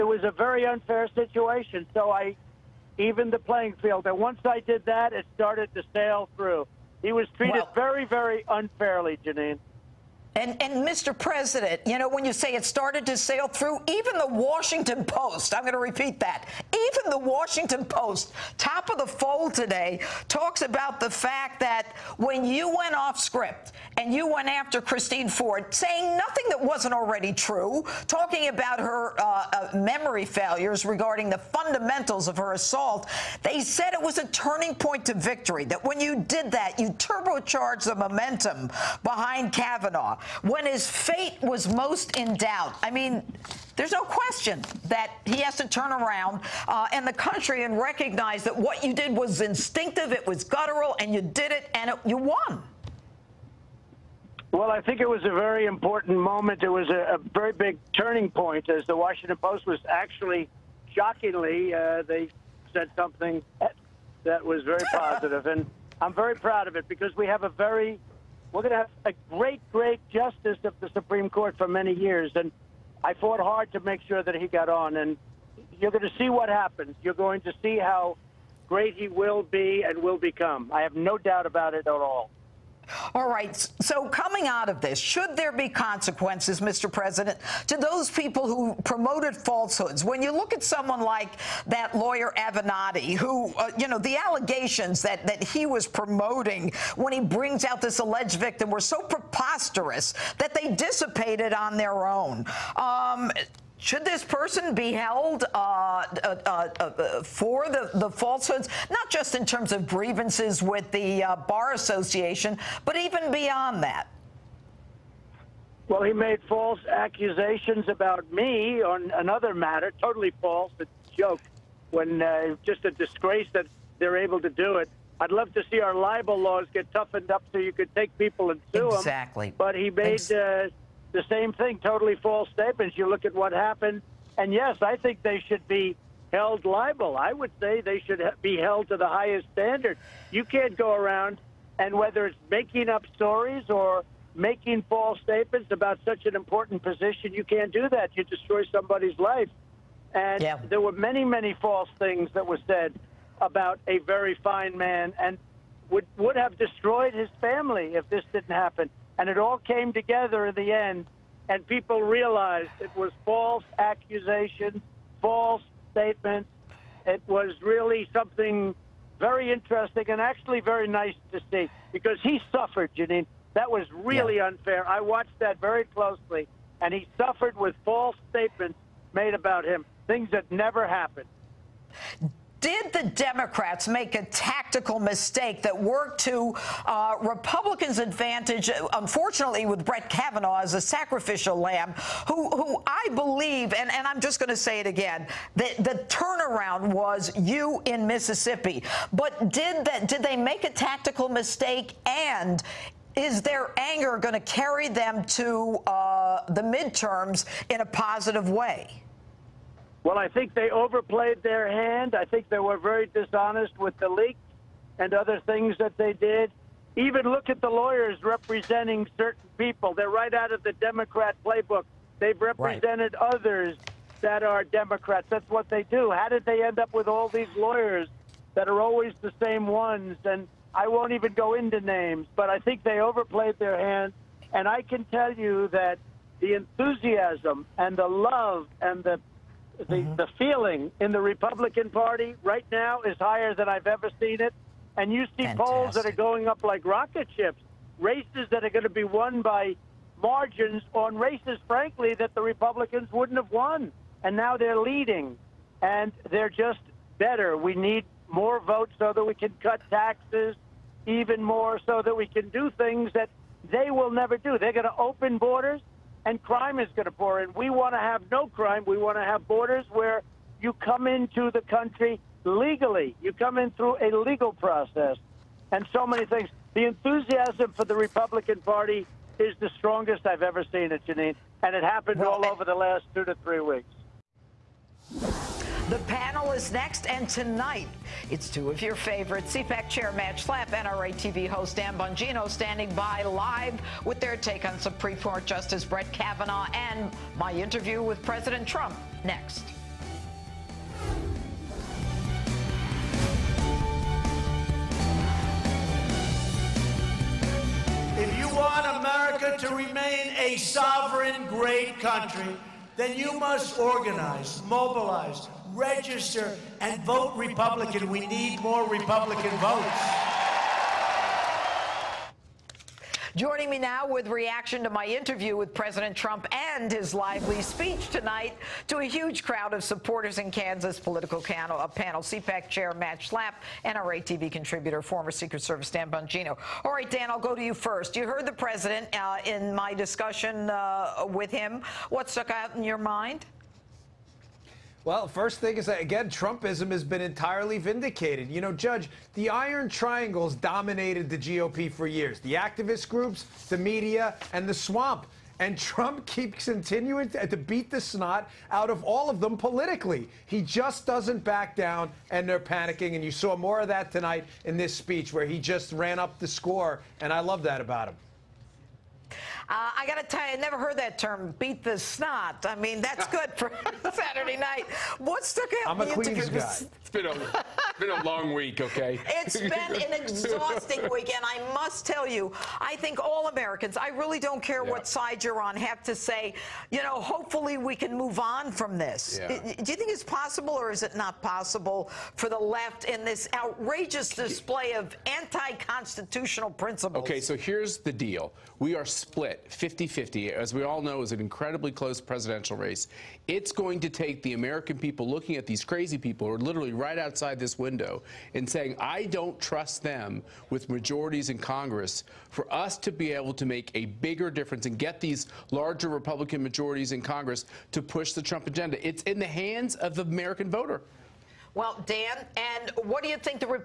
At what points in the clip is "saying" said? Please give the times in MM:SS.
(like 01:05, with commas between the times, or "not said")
00:25, 06:48.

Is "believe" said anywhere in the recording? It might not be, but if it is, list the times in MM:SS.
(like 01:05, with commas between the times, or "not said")
03:13.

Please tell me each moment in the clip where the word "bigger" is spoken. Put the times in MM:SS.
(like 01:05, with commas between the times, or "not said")
06:54.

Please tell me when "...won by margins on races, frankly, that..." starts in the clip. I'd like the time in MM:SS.
04:09.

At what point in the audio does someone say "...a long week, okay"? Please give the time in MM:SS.
06:18.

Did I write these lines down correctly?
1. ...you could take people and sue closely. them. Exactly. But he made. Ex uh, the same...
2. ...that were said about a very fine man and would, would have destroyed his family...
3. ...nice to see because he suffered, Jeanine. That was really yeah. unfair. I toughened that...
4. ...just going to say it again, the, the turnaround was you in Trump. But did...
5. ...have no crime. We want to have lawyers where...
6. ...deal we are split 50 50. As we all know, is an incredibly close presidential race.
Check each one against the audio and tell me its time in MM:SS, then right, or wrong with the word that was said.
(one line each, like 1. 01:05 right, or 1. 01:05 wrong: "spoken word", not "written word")
1. 02:07 wrong: "exactly", not "closely"
2. 02:32 right
3. 02:50 wrong: "watched", not "toughened"
4. 03:14 wrong: "Mississippi", not "Trump"
5. 04:27 wrong: "borders", not "lawyers"
6. 06:38 right.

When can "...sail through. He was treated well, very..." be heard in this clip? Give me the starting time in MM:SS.
00:05.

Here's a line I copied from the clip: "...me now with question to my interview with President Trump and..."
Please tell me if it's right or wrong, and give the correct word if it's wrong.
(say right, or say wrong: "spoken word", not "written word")
wrong: "reaction", not "question".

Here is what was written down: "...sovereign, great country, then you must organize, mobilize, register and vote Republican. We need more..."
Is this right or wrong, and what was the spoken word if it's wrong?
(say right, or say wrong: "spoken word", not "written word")
right.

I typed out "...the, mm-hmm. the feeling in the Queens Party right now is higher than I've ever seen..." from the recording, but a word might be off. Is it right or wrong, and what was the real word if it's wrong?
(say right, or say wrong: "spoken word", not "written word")
wrong: "Republican", not "Queens".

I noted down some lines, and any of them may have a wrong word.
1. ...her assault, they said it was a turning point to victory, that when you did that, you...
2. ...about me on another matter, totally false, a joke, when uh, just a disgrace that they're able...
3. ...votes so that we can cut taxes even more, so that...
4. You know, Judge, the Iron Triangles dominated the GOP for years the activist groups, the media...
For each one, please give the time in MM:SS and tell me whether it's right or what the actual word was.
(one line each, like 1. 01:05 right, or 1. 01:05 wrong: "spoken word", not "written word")
1. 00:32 right
2. 01:57 right
3. 04:18 right
4. 05:48 right.